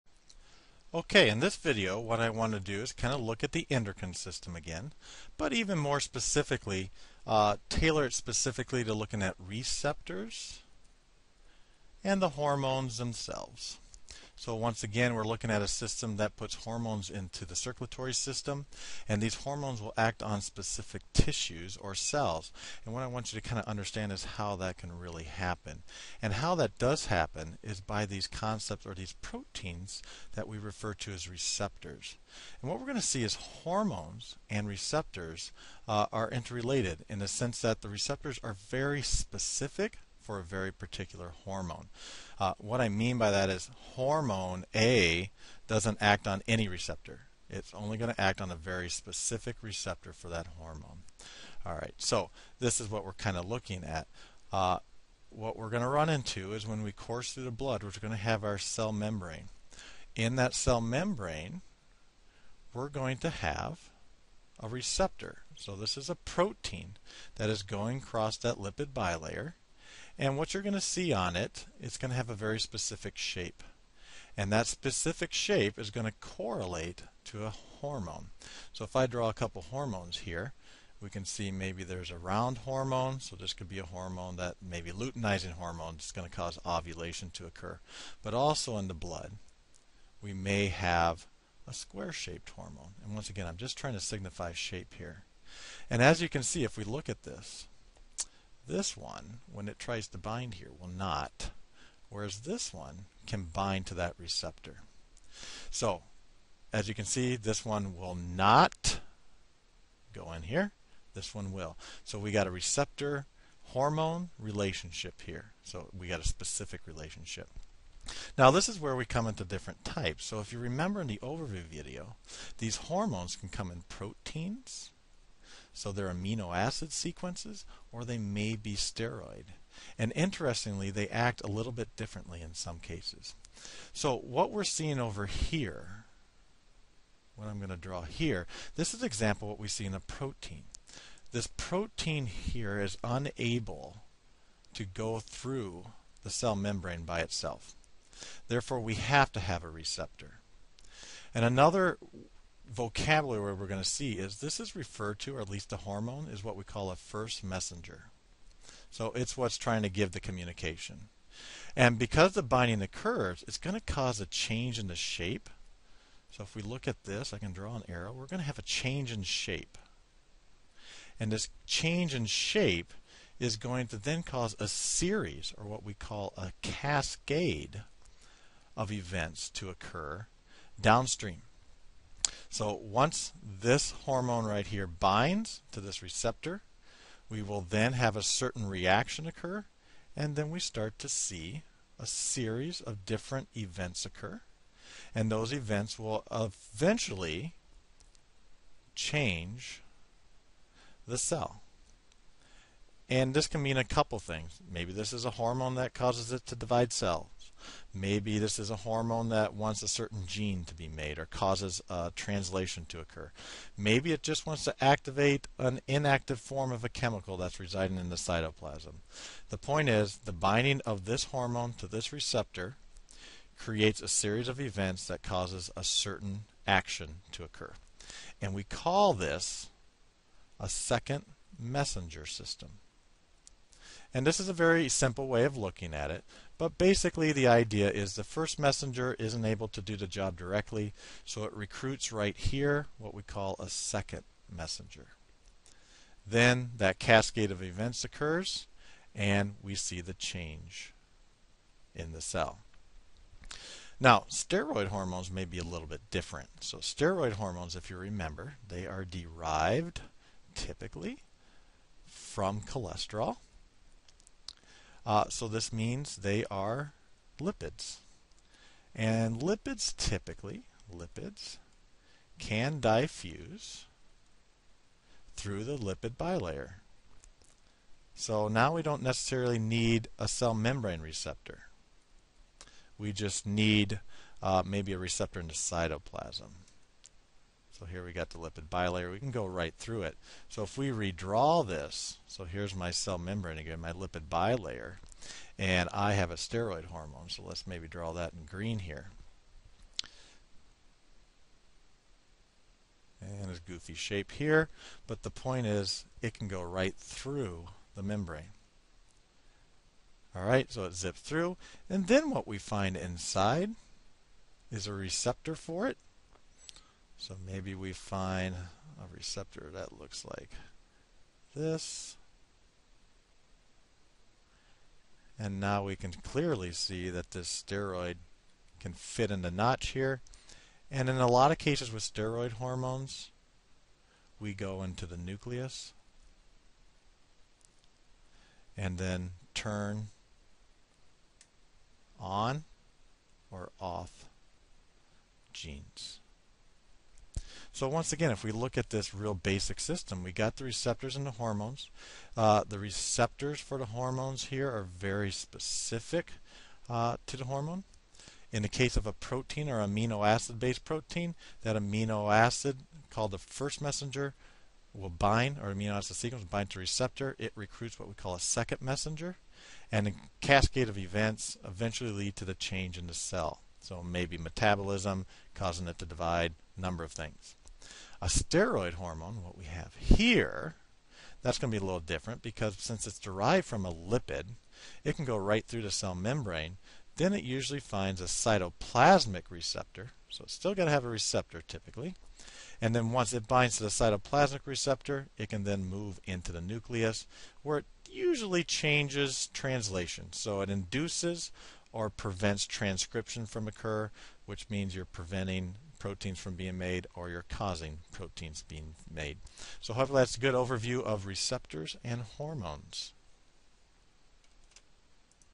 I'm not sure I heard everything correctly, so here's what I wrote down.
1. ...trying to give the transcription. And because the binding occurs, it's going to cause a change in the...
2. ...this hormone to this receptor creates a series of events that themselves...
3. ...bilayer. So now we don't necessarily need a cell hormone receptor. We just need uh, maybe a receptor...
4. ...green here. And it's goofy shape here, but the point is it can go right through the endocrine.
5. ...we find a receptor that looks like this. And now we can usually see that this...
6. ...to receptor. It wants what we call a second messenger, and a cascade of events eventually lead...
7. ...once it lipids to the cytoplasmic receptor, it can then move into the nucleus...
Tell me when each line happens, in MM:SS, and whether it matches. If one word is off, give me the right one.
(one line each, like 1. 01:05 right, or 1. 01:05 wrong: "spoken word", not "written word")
1. 02:39 wrong: "communication", not "transcription"
2. 03:41 wrong: "causes", not "themselves"
3. 04:36 wrong: "membrane", not "hormone"
4. 04:58 wrong: "membrane", not "endocrine"
5. 05:17 wrong: "clearly", not "usually"
6. 06:06 wrong: "recruits", not "wants"
7. 06:33 wrong: "binds", not "lipids".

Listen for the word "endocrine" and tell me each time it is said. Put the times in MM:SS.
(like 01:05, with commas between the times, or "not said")
00:03.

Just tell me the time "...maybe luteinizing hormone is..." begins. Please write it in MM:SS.
01:24.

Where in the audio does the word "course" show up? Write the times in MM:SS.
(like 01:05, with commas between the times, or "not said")
00:56.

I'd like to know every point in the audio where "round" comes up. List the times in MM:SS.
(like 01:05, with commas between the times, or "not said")
01:22.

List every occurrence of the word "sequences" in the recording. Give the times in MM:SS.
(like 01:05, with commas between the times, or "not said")
02:06, 06:06.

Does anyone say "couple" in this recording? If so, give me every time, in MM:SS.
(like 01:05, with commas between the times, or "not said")
01:19, 03:23.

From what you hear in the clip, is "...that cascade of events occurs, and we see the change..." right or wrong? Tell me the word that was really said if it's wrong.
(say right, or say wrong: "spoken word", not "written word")
right.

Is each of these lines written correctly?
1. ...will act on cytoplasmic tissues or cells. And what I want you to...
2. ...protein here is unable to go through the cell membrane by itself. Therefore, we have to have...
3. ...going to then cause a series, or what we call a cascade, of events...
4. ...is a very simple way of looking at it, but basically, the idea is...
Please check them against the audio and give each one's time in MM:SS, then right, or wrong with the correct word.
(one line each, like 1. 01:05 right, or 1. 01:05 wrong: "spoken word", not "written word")
1. 00:19 wrong: "specific", not "cytoplasmic"
2. 02:21 right
3. 02:53 right
4. 03:54 right.